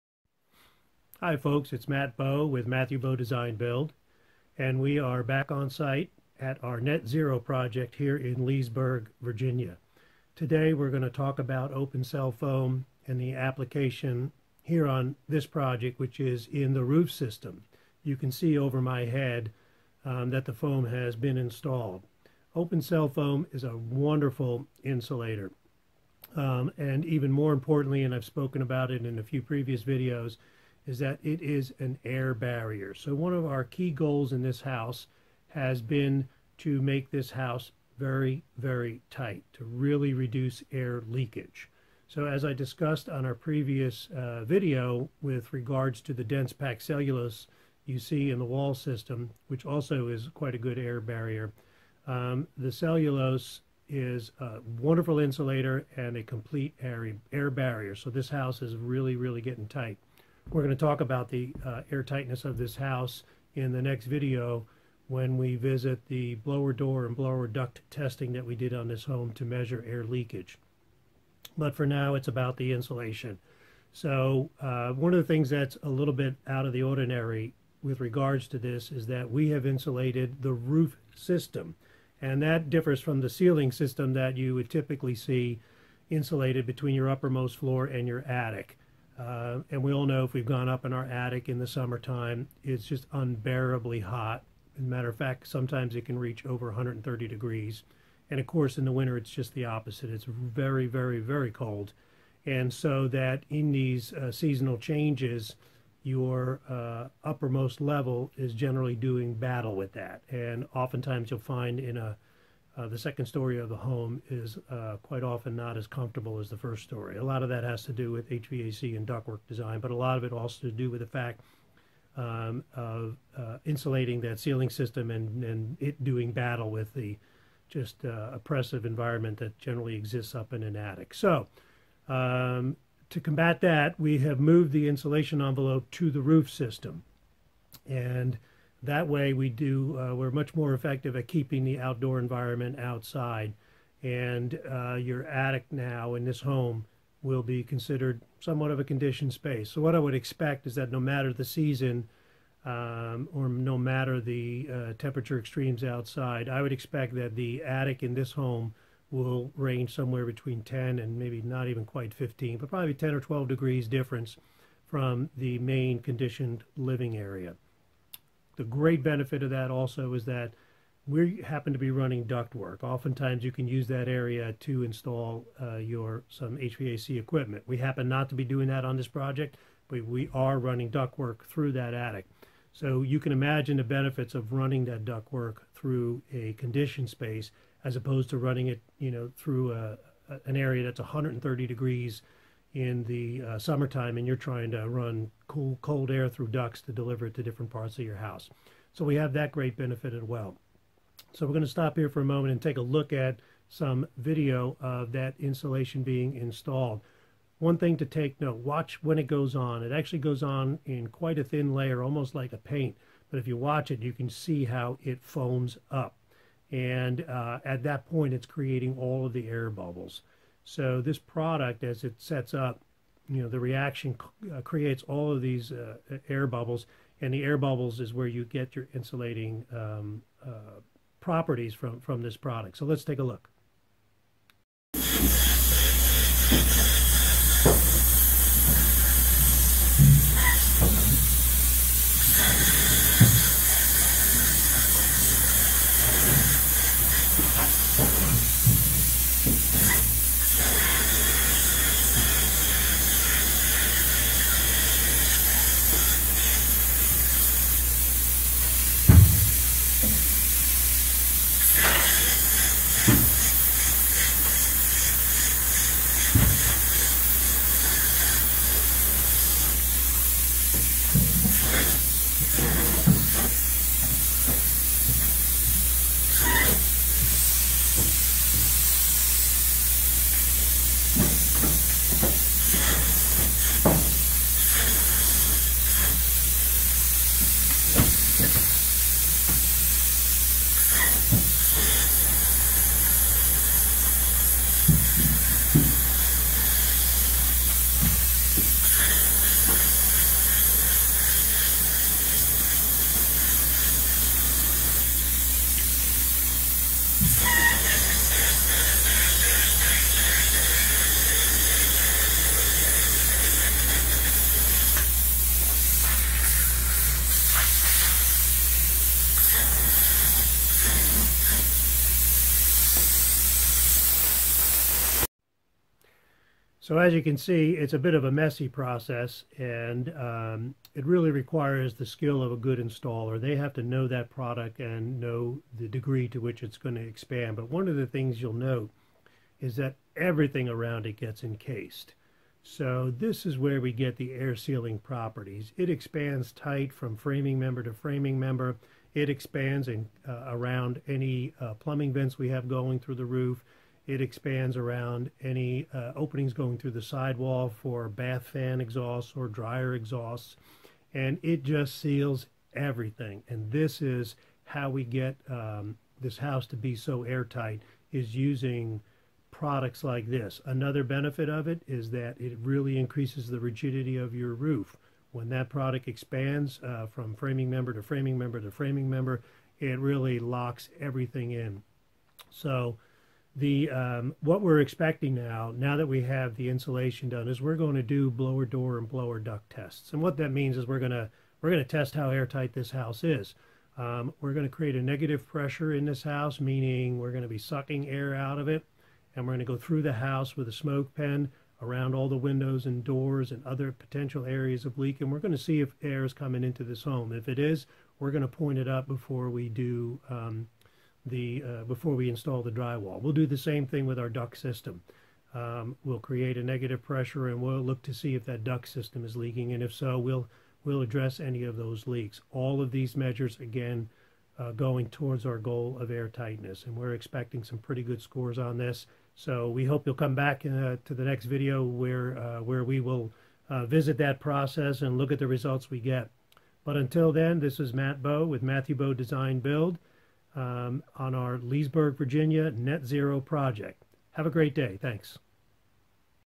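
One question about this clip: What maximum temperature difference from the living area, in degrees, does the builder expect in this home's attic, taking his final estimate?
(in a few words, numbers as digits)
12.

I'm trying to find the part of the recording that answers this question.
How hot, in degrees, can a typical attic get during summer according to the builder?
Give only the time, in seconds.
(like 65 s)
96 s.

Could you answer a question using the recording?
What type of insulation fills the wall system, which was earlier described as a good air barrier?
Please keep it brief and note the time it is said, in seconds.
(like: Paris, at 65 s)
Dense packed cellulose, at 46 s.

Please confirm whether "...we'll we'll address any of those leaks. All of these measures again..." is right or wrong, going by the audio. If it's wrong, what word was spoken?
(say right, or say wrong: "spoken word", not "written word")
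right.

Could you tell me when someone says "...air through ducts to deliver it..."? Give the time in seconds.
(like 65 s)
196 s.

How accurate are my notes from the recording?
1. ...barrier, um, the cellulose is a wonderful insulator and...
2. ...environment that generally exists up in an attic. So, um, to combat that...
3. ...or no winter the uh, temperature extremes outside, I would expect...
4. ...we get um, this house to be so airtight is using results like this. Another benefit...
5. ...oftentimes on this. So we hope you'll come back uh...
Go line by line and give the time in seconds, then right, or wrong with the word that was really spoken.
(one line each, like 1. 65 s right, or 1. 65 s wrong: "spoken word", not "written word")
1. 50 s right
2. 128 s right
3. 153 s wrong: "matter", not "winter"
4. 364 s wrong: "products", not "results"
5. 428 s wrong: "scores", not "oftentimes".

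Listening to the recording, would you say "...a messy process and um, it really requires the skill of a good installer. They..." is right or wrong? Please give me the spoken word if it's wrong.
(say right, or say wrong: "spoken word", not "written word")
right.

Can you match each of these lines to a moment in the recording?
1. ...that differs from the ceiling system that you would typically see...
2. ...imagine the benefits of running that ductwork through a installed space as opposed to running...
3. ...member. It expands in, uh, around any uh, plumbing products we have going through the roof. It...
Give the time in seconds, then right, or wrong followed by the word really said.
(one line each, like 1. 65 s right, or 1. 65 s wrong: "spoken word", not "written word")
1. 82 s right
2. 183 s wrong: "conditioned", not "installed"
3. 348 s wrong: "vents", not "products".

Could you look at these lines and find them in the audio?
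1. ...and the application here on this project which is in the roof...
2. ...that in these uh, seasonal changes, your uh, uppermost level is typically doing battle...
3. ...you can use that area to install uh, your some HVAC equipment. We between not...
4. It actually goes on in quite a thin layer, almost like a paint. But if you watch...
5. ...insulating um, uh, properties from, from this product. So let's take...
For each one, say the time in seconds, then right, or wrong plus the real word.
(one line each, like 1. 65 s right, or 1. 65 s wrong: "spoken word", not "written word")
1. 13 s right
2. 103 s wrong: "generally", not "typically"
3. 173 s wrong: "happen", not "between"
4. 209 s right
5. 228 s right.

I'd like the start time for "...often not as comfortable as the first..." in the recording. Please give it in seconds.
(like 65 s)
115 s.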